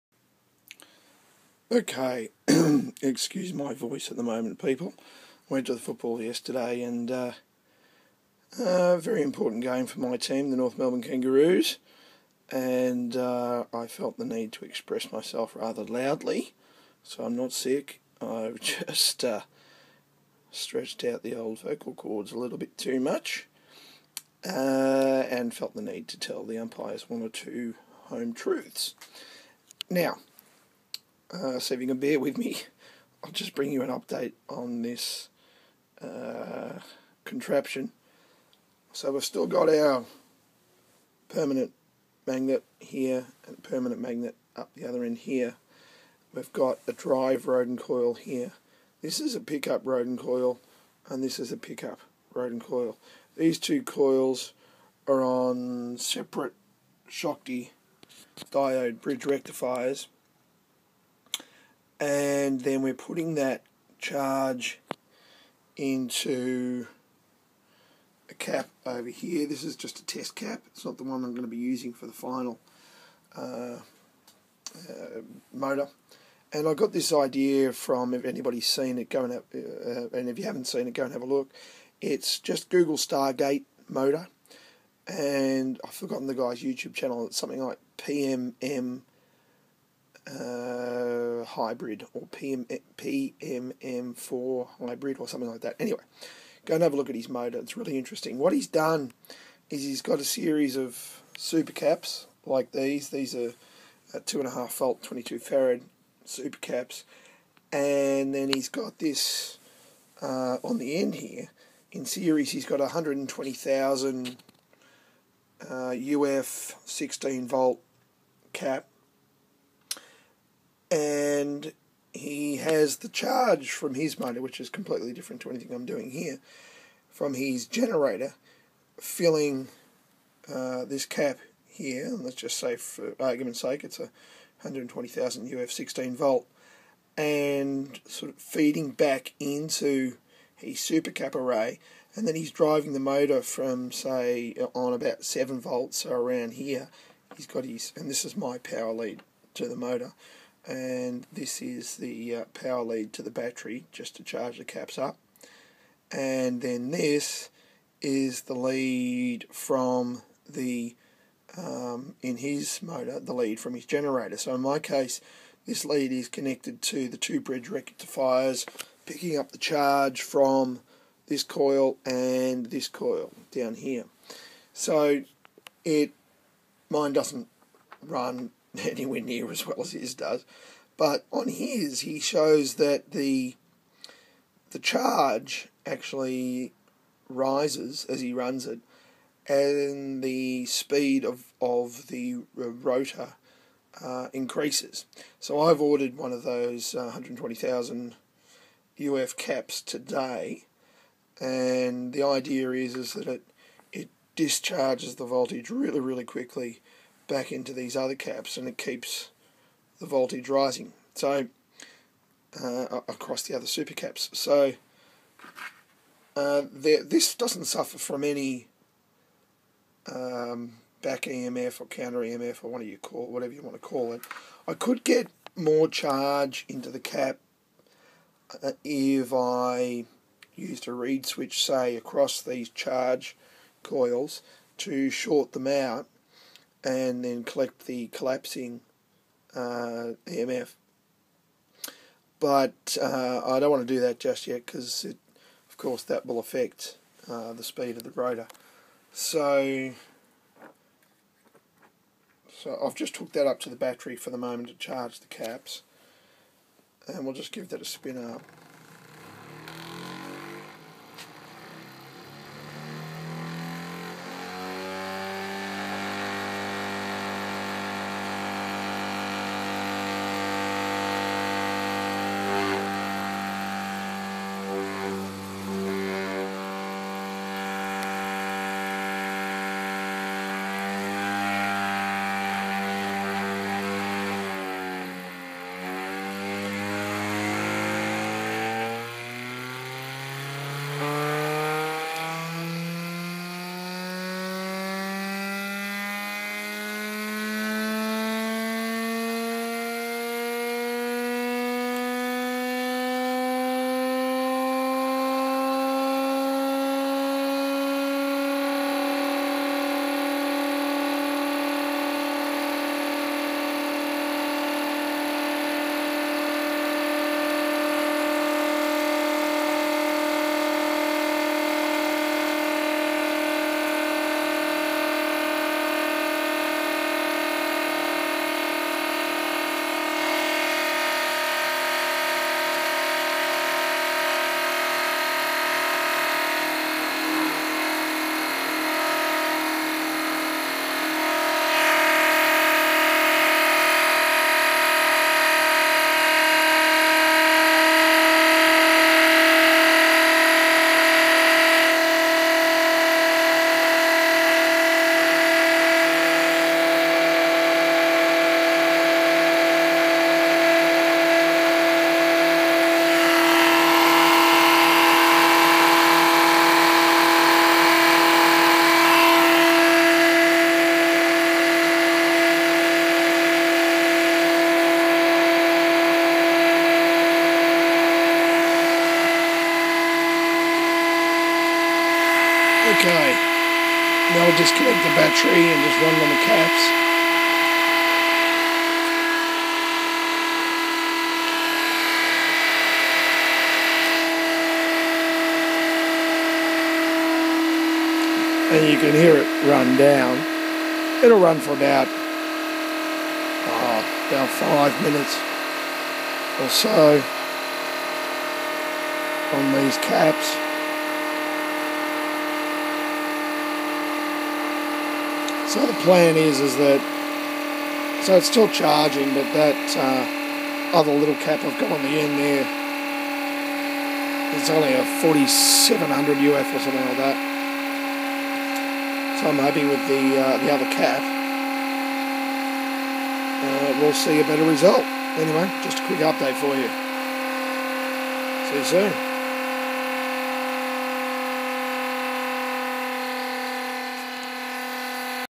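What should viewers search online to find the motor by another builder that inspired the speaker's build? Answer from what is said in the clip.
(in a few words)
Stargate motor.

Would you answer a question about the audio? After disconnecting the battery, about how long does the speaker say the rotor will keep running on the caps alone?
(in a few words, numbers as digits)
about five minutes.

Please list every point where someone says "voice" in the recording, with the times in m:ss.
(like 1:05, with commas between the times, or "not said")
0:03.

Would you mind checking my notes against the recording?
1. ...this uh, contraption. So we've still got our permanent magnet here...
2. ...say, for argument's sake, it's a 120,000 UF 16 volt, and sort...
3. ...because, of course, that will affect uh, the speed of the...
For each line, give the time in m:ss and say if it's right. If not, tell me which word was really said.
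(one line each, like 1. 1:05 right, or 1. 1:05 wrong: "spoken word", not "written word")
1. 0:34 right
2. 2:12 right
3. 4:04 right.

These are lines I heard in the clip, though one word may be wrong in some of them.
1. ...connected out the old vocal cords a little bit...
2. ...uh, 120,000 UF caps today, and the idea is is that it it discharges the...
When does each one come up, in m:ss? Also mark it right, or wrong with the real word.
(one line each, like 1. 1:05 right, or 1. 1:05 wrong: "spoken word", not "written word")
1. 0:20 wrong: "stretched", not "connected"
2. 3:16 right.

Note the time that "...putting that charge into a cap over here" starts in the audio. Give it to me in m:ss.
1:02.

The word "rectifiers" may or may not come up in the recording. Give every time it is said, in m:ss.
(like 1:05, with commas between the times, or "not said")
0:59, 2:47.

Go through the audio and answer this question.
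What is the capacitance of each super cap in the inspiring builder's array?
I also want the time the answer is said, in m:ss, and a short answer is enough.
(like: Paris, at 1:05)
22 farad, at 1:45.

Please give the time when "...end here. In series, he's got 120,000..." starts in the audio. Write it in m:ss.
1:50.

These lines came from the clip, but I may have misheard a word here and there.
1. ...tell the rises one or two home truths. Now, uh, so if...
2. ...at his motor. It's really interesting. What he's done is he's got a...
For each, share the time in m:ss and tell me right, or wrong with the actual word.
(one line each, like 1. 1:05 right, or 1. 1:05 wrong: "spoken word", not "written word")
1. 0:26 wrong: "umpires", not "rises"
2. 1:37 right.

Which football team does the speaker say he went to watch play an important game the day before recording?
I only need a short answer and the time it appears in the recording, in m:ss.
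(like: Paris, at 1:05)
North Melbourne Kangaroos, at 0:10.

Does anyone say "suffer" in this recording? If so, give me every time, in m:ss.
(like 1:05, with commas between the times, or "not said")
3:37.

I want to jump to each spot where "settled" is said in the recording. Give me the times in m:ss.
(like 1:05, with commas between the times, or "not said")
not said.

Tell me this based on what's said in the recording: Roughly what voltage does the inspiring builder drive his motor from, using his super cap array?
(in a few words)
7 volts.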